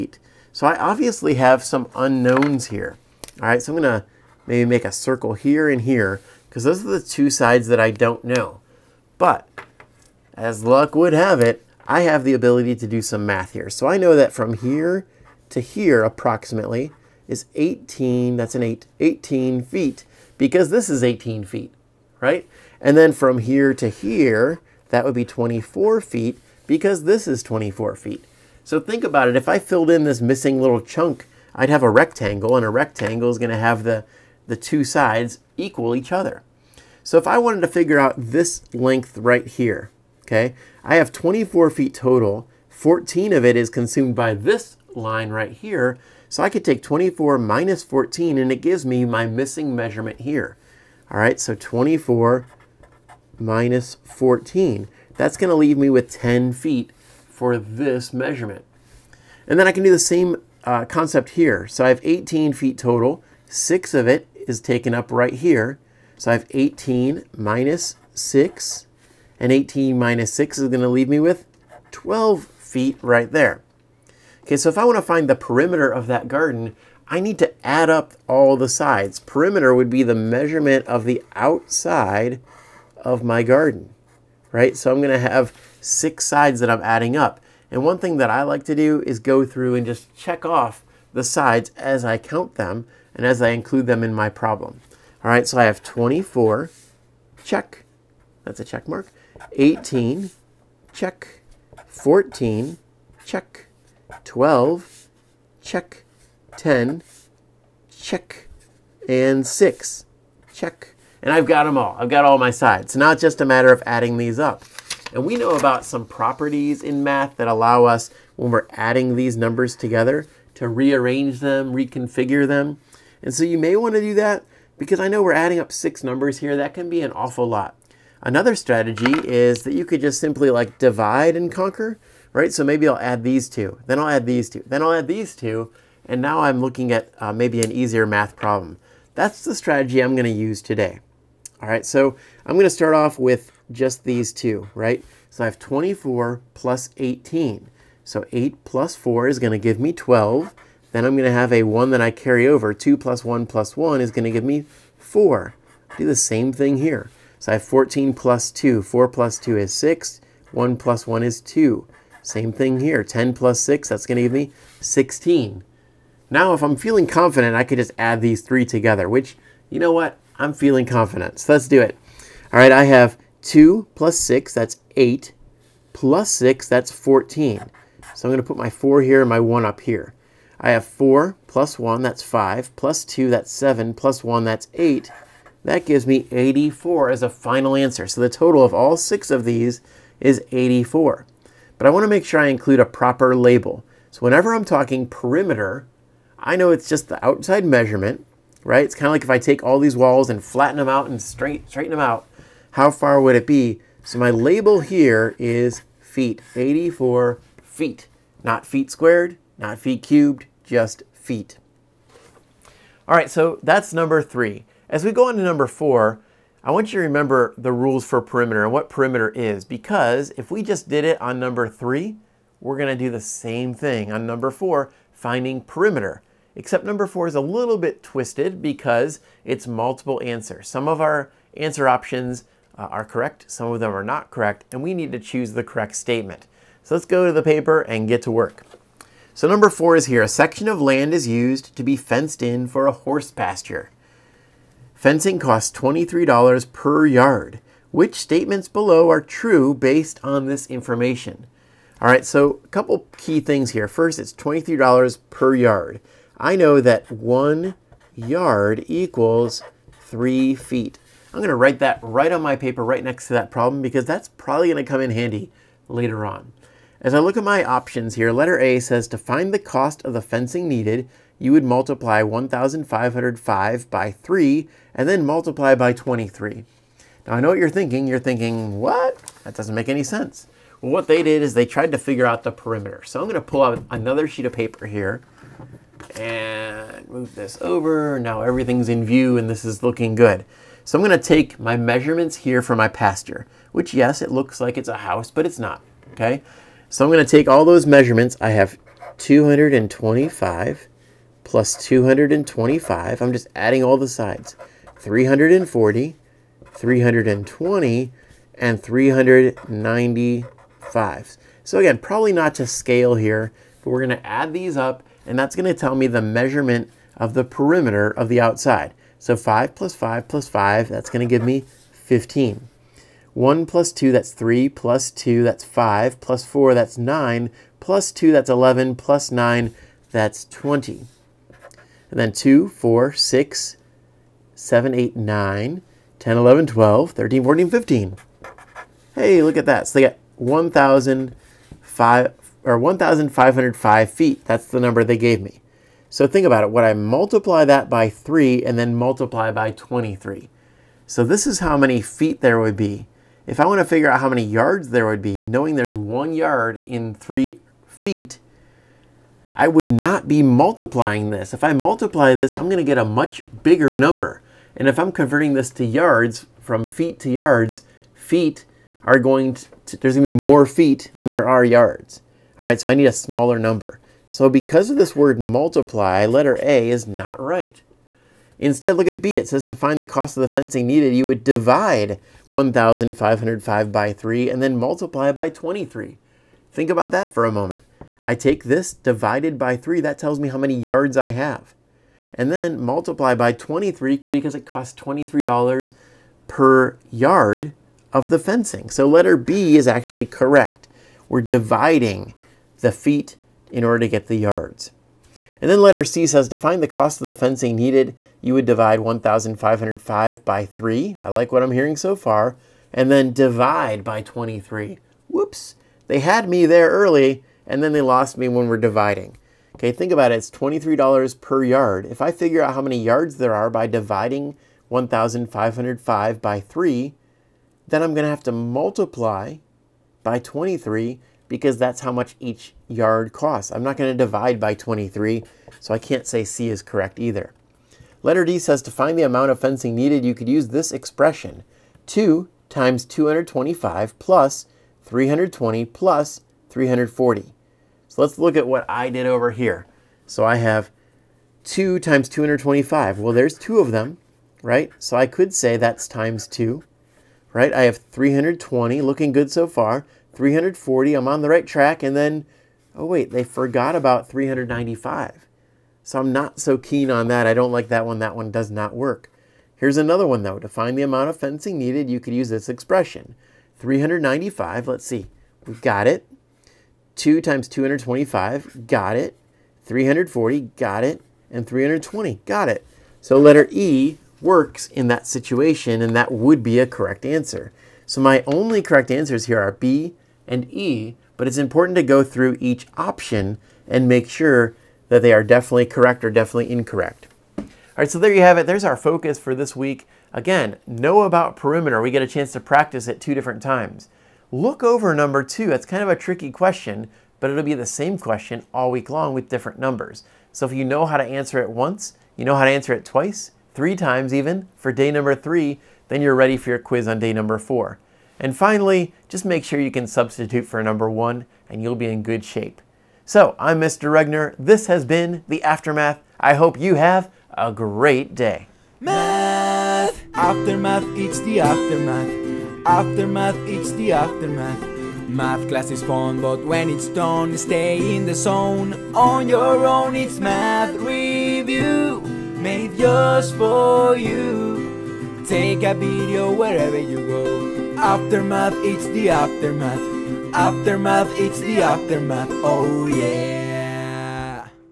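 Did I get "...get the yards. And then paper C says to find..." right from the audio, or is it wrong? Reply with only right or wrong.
wrong.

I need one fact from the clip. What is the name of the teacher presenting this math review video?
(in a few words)
Mr. Regner.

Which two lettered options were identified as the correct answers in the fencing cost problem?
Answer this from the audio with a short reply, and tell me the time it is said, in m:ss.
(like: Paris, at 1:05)
B and E, at 8:09.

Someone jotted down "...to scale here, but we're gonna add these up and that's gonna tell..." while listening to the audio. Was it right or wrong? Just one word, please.
right.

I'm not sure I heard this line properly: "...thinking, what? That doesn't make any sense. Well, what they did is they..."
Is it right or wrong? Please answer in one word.
right.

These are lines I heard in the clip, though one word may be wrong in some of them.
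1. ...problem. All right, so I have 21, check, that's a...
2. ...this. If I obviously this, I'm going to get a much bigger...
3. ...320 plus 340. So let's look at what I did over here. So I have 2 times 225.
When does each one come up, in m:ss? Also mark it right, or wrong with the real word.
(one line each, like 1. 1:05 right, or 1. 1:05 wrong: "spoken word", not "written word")
1. 1:34 wrong: "24", not "21"
2. 6:01 wrong: "multiply", not "obviously"
3. 7:25 right.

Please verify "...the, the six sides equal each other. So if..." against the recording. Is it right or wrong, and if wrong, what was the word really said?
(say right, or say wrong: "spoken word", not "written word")
wrong: "two", not "six".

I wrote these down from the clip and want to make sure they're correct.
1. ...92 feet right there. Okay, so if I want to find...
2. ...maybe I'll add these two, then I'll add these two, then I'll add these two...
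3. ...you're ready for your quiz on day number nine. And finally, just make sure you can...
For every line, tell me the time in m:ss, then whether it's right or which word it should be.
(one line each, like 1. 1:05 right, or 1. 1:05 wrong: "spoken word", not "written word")
1. 1:11 wrong: "12", not "92"
2. 2:12 right
3. 8:36 wrong: "four", not "nine".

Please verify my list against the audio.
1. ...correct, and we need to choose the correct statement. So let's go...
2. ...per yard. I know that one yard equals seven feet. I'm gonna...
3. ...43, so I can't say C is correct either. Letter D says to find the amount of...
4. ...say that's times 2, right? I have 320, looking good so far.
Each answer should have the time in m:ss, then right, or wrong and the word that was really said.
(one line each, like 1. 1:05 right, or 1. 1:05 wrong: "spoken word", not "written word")
1. 3:54 right
2. 4:15 wrong: "three", not "seven"
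3. 7:14 wrong: "23", not "43"
4. 7:35 right.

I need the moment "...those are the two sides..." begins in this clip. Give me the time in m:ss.
0:06.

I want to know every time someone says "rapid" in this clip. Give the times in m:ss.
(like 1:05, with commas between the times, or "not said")
not said.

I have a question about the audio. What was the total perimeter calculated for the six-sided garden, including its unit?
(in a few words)
84 feet.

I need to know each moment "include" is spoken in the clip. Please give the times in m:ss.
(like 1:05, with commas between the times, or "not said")
1:33, 3:12.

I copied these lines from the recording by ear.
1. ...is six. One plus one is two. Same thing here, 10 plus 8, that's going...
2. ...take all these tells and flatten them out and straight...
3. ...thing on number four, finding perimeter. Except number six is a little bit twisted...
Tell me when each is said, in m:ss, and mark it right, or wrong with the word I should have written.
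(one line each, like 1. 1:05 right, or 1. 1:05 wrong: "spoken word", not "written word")
1. 2:39 wrong: "6", not "8"
2. 3:19 wrong: "walls", not "tells"
3. 3:43 wrong: "four", not "six".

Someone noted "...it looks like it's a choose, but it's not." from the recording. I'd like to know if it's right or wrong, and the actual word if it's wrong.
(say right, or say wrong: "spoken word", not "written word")
wrong: "house", not "choose".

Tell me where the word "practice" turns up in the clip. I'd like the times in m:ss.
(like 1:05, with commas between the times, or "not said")
8:22.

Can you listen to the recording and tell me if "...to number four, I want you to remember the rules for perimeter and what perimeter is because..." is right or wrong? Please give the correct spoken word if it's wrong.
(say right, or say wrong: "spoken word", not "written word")
right.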